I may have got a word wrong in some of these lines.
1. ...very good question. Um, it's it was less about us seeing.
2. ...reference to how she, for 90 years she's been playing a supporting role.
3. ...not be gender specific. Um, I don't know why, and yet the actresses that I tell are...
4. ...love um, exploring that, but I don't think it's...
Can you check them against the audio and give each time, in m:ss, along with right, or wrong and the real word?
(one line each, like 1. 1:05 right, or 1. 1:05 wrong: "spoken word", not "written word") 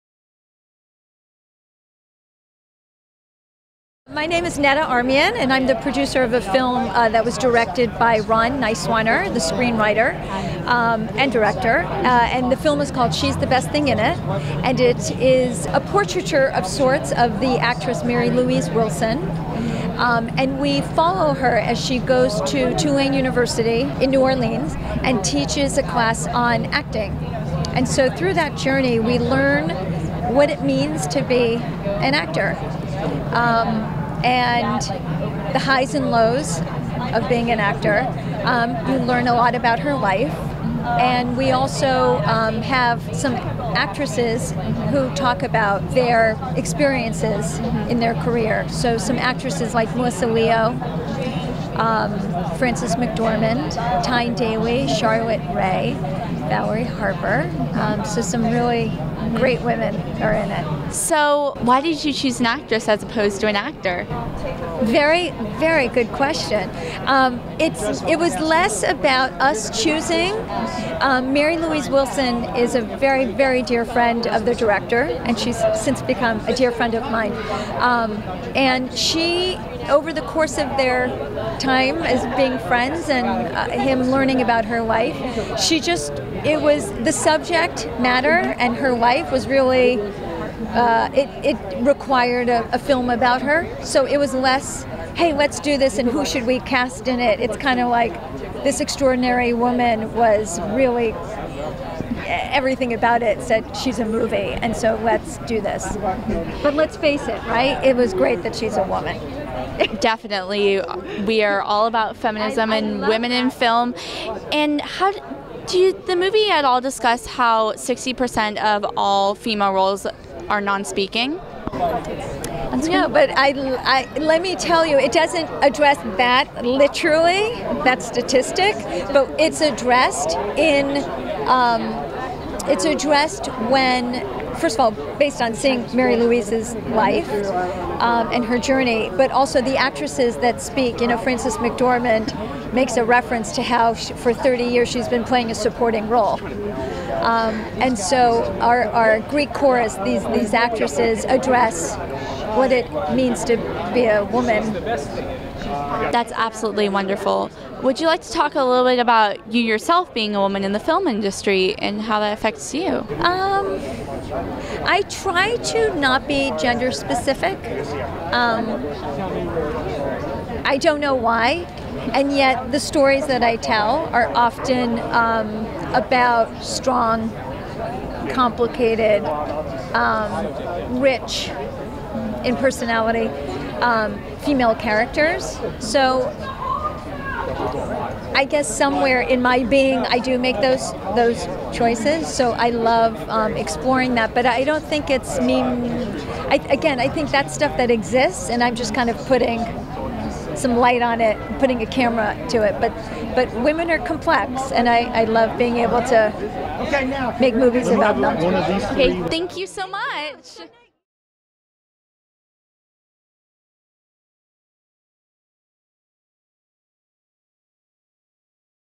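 1. 1:05 wrong: "choosing", not "seeing"
2. 2:23 wrong: "30", not "90"
3. 2:45 wrong: "stories", not "actresses"
4. 3:12 right.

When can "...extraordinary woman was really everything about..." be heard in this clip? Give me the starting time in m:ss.
1:38.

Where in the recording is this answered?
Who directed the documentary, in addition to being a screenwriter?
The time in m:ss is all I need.
0:08.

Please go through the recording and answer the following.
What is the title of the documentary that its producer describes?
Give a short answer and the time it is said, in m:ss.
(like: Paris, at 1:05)
She's the Best Thing in It, at 0:13.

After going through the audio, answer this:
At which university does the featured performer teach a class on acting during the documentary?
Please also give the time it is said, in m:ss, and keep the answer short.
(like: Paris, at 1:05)
Tulane University, at 0:22.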